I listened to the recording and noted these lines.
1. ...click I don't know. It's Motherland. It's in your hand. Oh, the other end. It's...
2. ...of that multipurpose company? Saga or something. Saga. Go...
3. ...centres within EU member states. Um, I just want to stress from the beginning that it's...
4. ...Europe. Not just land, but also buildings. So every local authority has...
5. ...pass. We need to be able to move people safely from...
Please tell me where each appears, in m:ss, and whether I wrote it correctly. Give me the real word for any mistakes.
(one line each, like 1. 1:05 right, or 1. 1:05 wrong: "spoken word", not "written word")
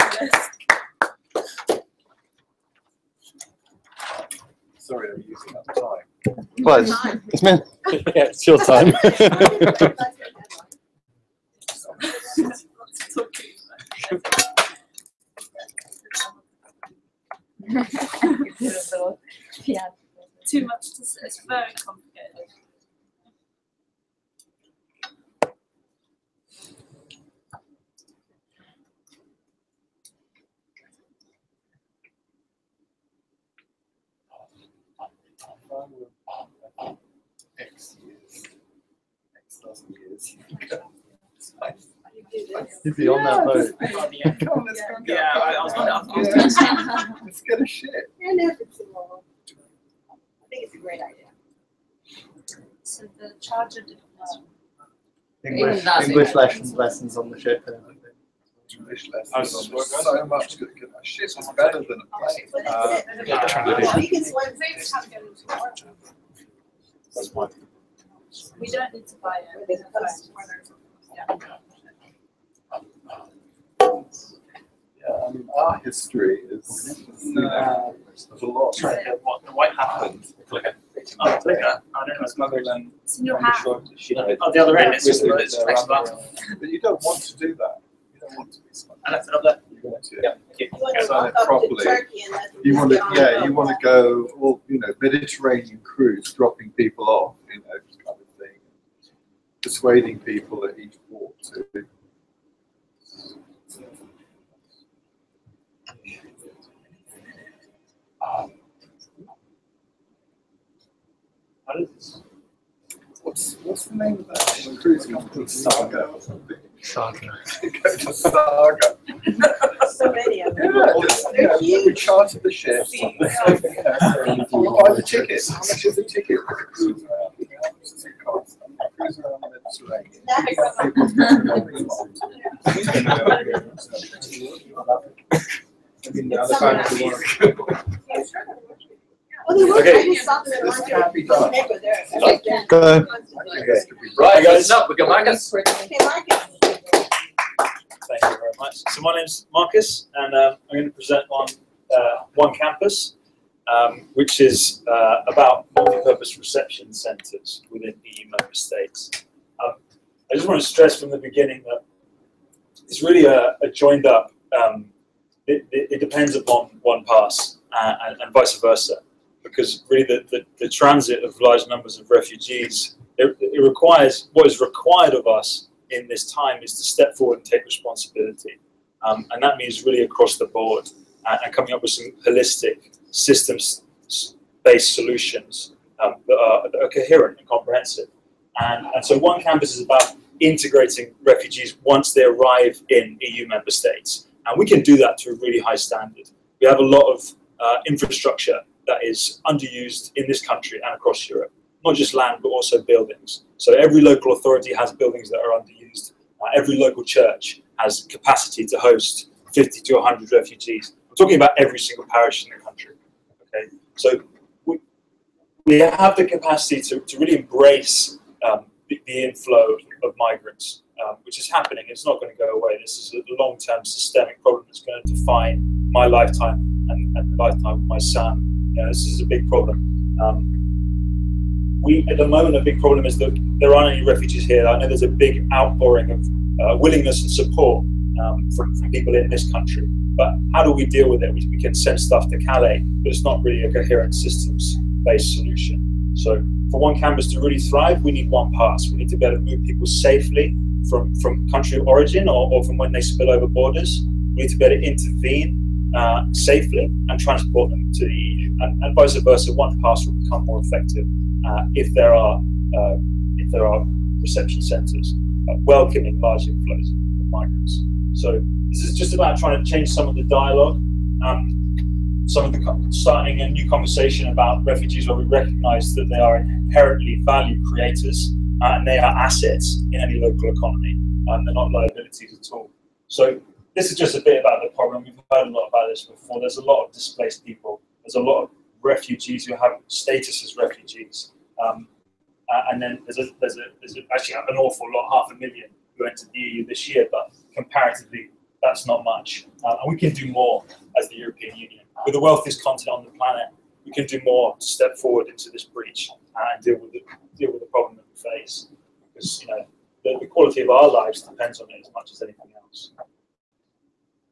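1. 1:21 right
2. 1:54 wrong: "cruise", not "multipurpose"
3. 2:36 right
4. 3:21 right
5. 4:08 right.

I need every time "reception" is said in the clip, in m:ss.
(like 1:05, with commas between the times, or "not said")
2:36, 4:24.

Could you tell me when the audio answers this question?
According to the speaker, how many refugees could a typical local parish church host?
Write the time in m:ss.
3:29.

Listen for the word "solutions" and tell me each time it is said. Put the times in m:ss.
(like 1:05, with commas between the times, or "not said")
3:04, 4:05.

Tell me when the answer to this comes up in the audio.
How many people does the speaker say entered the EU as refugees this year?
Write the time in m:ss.
4:55.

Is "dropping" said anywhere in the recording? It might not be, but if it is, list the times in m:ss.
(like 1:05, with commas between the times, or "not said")
1:36.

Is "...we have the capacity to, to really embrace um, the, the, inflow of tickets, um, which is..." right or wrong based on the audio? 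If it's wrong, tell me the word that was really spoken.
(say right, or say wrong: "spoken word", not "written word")
wrong: "migrants", not "tickets".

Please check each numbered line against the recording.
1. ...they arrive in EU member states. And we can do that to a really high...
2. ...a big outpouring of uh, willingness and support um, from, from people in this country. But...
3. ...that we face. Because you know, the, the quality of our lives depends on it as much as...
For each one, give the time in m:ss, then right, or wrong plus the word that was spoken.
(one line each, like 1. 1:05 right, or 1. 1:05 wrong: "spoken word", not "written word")
1. 3:12 right
2. 3:55 right
3. 5:07 right.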